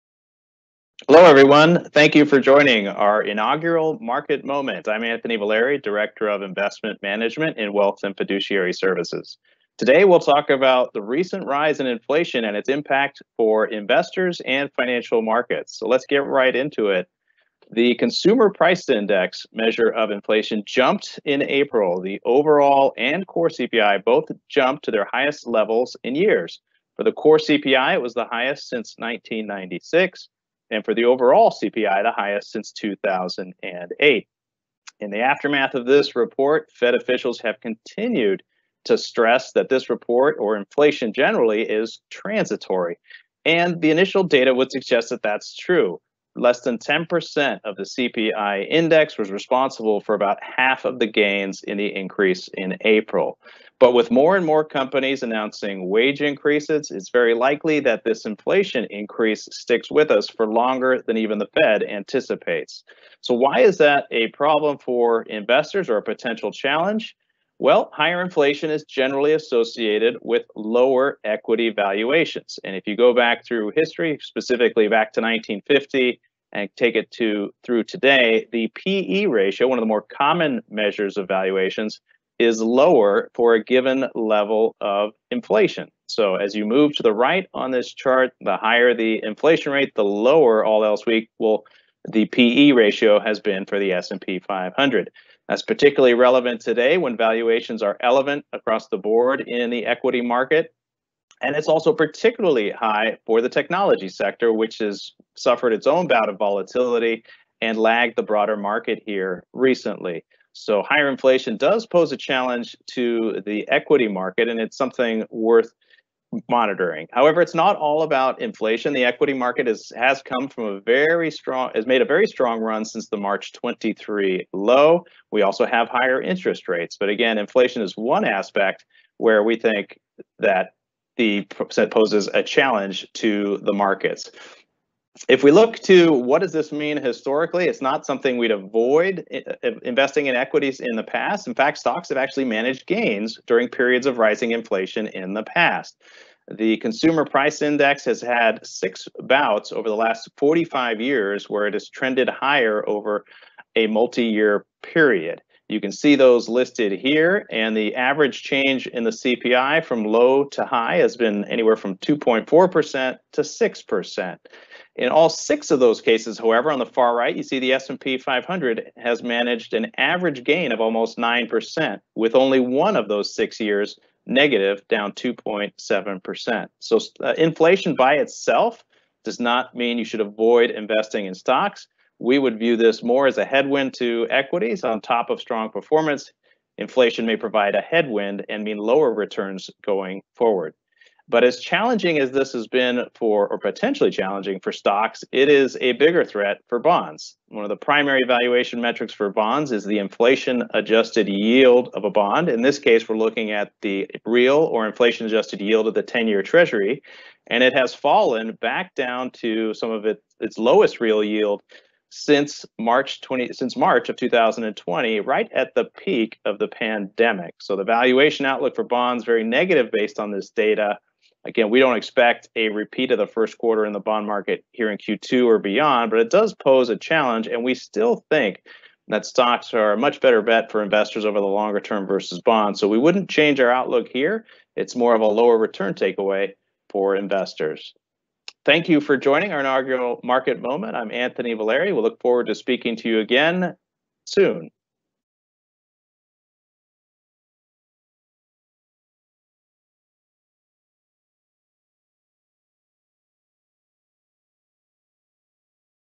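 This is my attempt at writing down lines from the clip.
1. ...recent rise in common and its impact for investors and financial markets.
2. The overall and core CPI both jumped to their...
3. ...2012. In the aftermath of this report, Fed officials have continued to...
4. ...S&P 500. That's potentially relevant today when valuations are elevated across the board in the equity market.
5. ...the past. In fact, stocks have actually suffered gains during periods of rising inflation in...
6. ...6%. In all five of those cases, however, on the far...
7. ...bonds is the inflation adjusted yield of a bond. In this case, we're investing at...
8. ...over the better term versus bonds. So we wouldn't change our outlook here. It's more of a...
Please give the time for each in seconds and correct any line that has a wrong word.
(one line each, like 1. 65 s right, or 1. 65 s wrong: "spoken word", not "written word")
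1. 11 s wrong: "inflation", not "common"
2. 21 s right
3. 32 s wrong: "2008", not "2012"
4. 93 s wrong: "particularly", not "potentially"
5. 140 s wrong: "managed", not "suffered"
6. 163 s wrong: "six", not "five"
7. 199 s wrong: "looking", not "investing"
8. 231 s wrong: "longer", not "better".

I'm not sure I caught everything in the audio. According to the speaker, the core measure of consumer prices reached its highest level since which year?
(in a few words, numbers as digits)
1996.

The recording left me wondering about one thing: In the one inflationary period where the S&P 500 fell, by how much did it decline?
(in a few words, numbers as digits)
2.7%.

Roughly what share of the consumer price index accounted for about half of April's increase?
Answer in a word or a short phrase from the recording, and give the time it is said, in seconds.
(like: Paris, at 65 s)
less than 10%, at 46 s.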